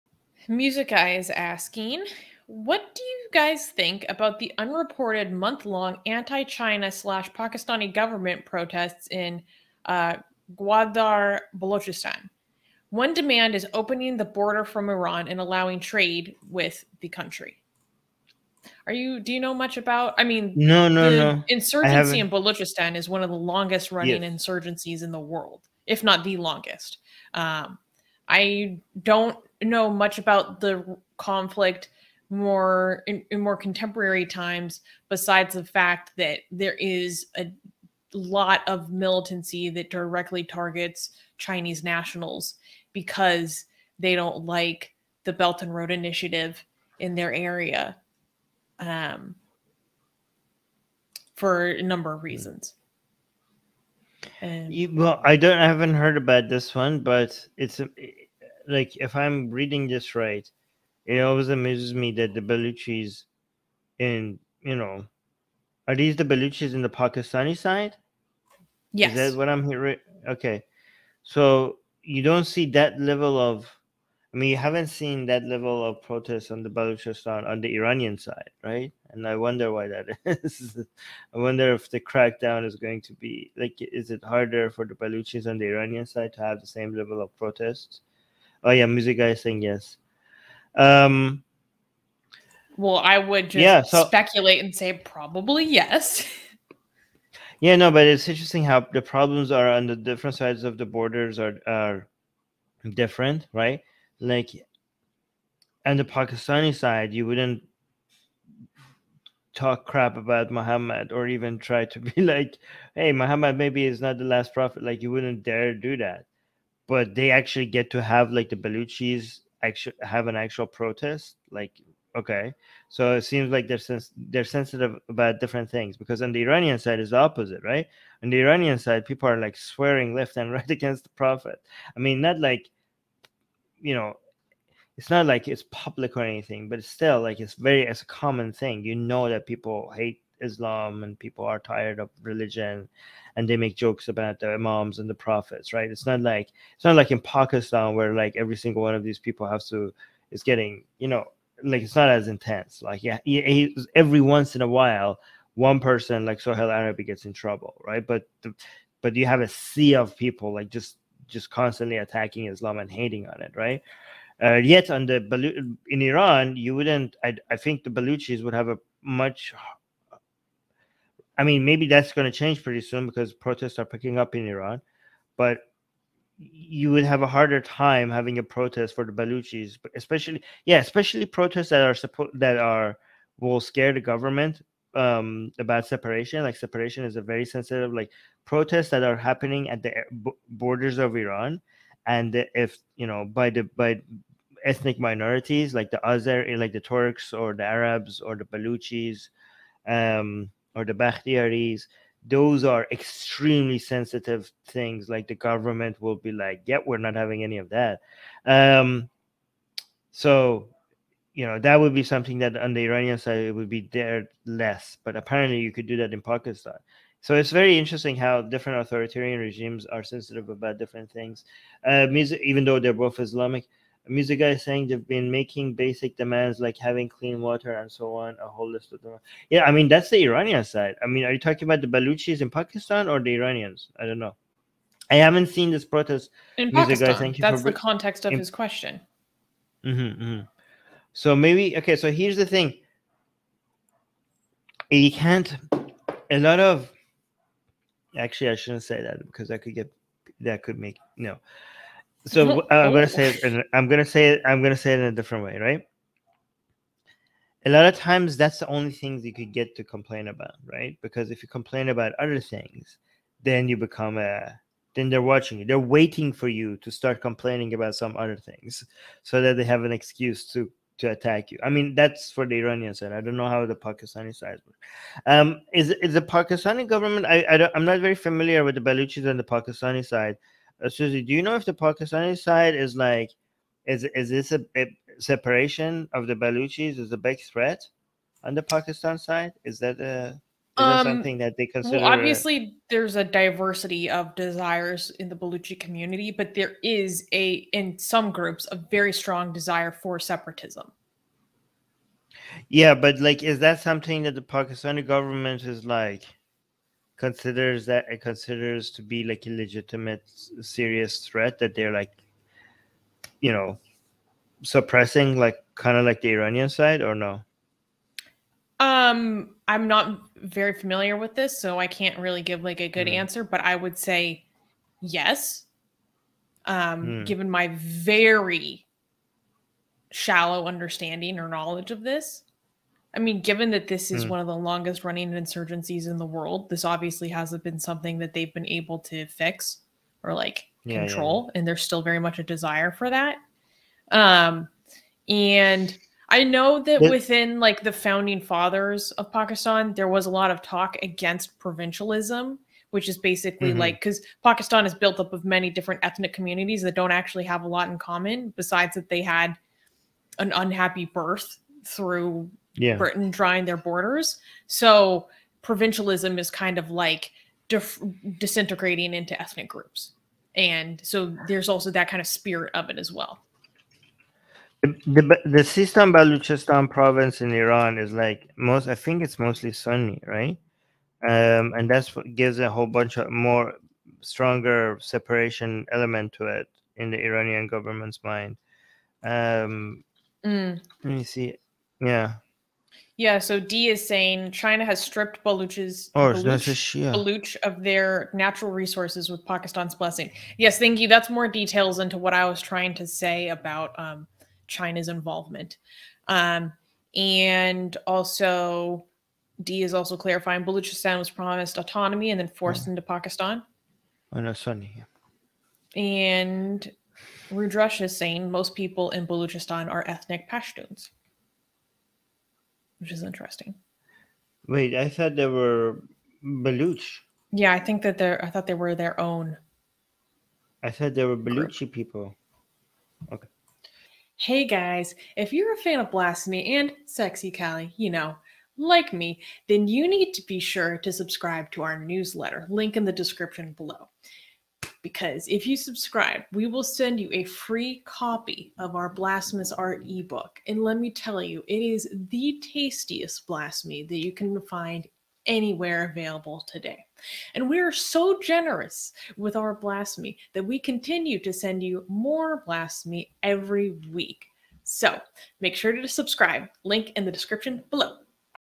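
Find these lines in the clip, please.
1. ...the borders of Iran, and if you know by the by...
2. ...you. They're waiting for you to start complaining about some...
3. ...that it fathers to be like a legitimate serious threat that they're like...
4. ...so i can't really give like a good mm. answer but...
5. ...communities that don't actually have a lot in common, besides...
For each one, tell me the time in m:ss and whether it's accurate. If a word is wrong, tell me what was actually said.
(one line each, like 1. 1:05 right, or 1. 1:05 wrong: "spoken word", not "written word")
1. 3:09 right
2. 4:25 right
3. 5:07 wrong: "considers", not "fathers"
4. 5:21 right
5. 5:56 right.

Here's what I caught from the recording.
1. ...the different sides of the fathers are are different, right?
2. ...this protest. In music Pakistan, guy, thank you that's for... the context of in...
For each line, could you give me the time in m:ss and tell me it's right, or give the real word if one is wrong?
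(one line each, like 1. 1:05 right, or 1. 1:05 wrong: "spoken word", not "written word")
1. 1:39 wrong: "borders", not "fathers"
2. 3:55 right.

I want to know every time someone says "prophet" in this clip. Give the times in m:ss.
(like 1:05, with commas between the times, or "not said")
1:54, 2:11, 2:25.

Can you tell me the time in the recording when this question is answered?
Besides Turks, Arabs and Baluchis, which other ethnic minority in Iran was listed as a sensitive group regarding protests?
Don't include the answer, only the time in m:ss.
3:20.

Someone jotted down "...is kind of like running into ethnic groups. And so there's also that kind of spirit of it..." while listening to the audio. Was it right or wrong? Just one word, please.
wrong.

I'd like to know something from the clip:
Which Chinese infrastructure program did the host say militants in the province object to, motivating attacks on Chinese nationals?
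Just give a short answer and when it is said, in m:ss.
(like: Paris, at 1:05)
Belt and Road Initiative, at 0:45.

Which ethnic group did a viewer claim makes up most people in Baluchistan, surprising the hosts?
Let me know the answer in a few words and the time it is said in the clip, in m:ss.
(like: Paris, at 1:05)
Pashtuns, at 7:00.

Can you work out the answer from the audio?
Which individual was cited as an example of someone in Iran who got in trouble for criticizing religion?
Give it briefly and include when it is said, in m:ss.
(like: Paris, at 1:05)
Soheil Arabi, at 2:36.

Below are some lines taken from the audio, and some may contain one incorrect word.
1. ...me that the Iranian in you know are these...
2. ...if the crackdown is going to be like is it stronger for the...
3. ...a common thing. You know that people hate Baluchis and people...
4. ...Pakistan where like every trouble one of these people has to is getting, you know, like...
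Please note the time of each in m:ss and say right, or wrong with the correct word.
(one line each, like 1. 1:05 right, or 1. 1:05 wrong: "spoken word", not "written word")
1. 1:01 wrong: "Baluchis", not "Iranian"
2. 1:21 wrong: "harder", not "stronger"
3. 2:18 wrong: "Islam", not "Baluchis"
4. 2:27 wrong: "single", not "trouble".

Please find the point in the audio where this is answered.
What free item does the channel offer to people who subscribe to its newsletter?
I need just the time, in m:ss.
7:29.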